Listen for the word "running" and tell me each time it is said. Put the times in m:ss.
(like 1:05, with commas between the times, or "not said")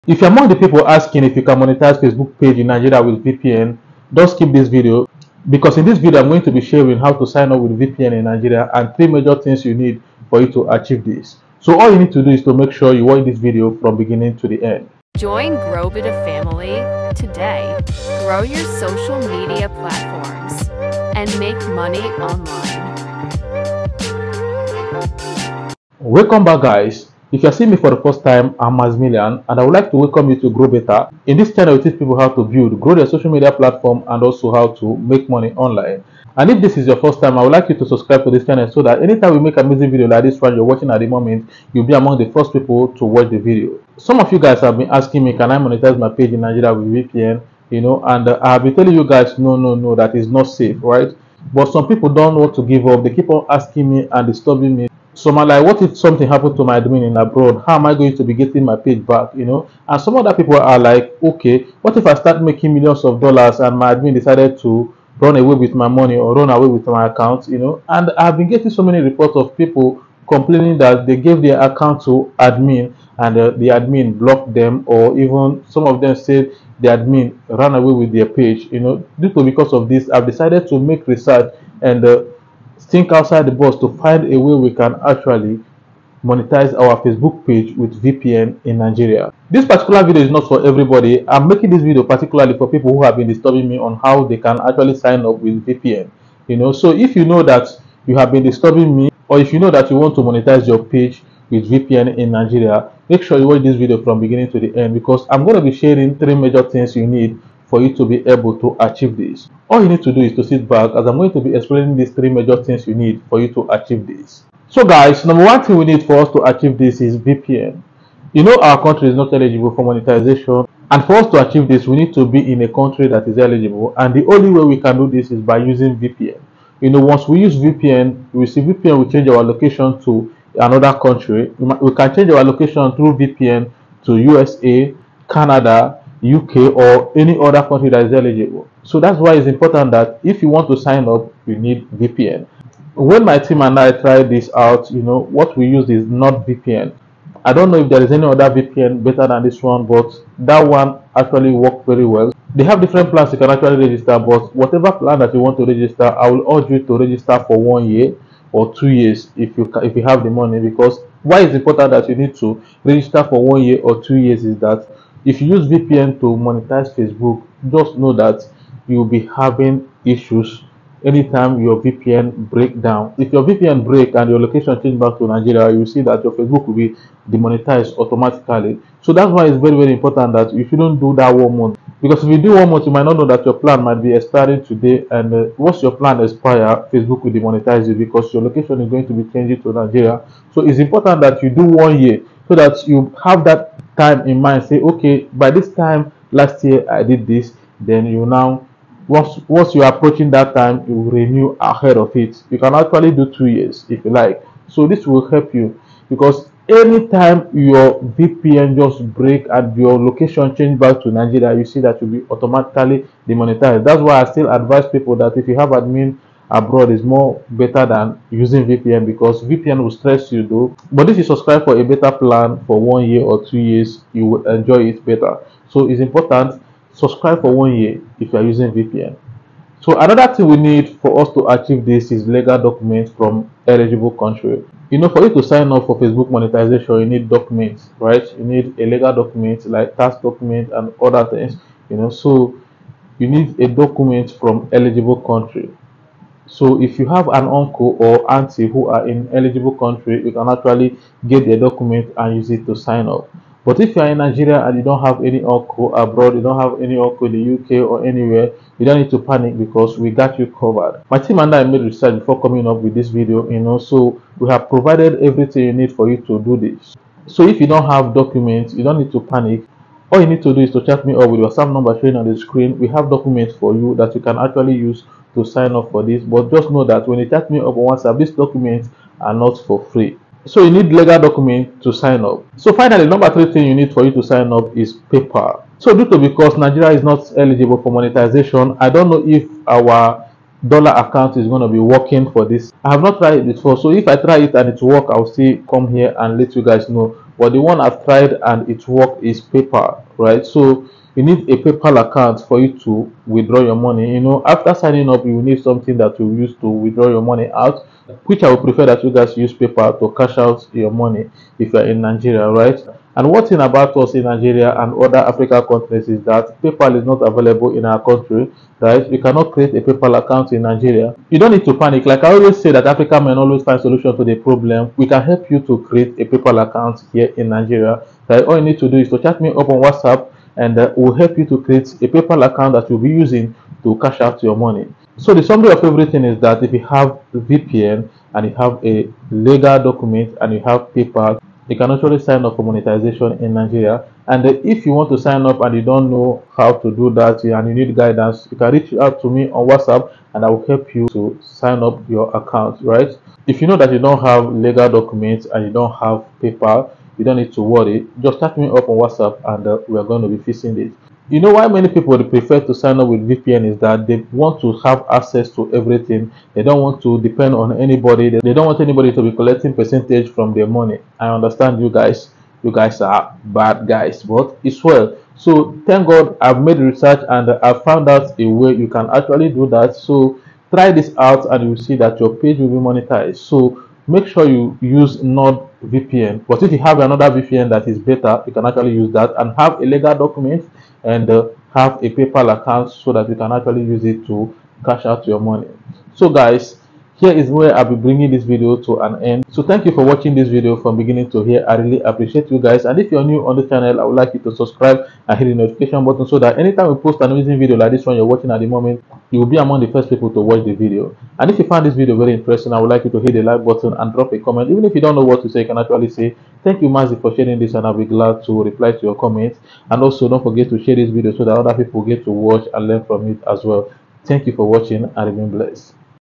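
not said.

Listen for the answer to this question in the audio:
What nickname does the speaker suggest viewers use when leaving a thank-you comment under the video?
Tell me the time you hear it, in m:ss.
6:56.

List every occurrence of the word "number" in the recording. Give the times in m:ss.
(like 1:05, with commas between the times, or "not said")
1:55, 4:31, 4:43.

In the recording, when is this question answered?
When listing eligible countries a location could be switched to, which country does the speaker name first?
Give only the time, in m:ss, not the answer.
2:14.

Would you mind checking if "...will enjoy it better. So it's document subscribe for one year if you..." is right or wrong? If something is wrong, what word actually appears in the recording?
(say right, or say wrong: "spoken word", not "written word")
wrong: "important", not "document".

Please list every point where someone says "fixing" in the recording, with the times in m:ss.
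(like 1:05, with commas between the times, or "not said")
6:00.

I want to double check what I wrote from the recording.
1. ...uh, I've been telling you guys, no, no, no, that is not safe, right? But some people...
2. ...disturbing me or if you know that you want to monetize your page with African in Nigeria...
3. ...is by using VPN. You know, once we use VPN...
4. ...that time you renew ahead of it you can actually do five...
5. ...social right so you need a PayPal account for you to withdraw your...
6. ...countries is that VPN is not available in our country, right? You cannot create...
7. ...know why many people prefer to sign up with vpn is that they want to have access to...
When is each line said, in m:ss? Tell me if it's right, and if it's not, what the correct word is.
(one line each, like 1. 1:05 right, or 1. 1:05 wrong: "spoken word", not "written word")
1. 0:48 right
2. 1:38 wrong: "VPN", not "African"
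3. 2:05 right
4. 3:20 wrong: "two", not "five"
5. 4:59 wrong: "paypal", not "social"
6. 5:15 wrong: "PayPal", not "VPN"
7. 6:01 right.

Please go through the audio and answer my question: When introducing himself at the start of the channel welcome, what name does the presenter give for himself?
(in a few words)
Maximilian.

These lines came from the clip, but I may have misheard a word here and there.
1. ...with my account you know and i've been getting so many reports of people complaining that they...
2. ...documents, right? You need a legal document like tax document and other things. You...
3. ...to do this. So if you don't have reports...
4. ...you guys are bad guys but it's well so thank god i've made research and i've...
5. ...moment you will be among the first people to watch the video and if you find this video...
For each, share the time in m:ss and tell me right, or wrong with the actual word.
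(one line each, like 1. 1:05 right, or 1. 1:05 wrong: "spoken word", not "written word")
1. 1:06 right
2. 3:57 right
3. 4:26 wrong: "documents", not "reports"
4. 6:12 right
5. 6:48 right.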